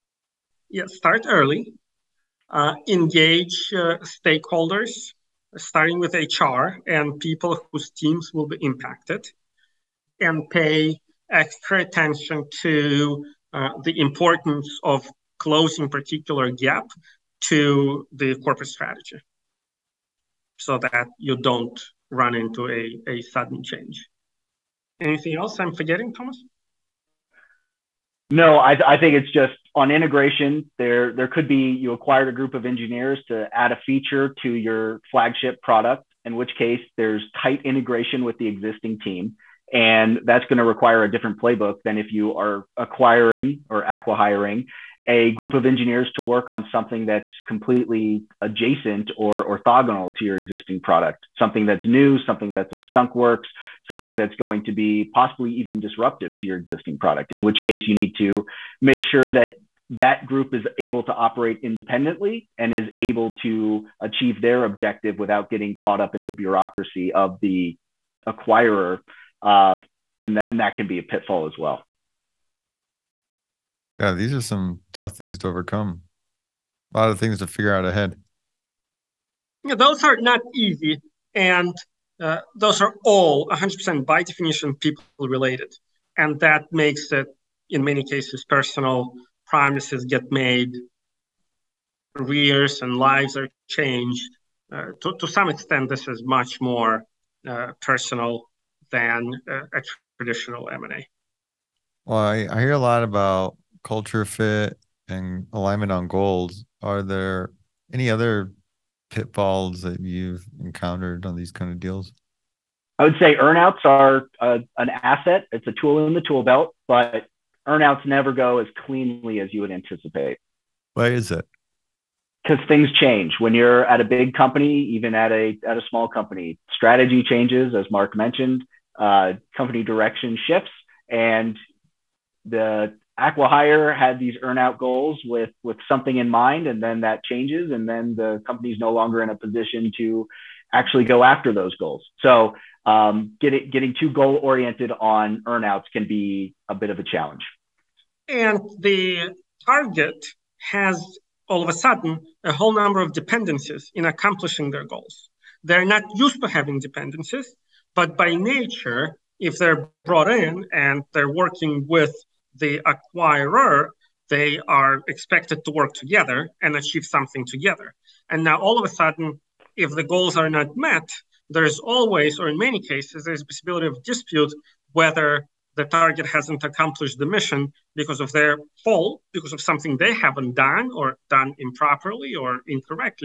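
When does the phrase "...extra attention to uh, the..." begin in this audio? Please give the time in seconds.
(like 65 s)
11 s.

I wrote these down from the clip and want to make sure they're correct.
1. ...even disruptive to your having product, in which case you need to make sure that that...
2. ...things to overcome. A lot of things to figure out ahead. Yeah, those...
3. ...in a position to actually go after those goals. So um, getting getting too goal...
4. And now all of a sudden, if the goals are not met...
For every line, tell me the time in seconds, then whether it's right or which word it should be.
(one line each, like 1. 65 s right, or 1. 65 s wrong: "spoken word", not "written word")
1. 55 s wrong: "existing", not "having"
2. 75 s right
3. 139 s right
4. 168 s right.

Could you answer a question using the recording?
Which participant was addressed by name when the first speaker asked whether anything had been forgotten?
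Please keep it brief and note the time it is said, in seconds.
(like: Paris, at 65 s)
Thomas, at 26 s.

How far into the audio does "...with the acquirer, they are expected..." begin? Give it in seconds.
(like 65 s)
161 s.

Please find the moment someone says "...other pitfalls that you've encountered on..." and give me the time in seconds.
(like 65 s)
108 s.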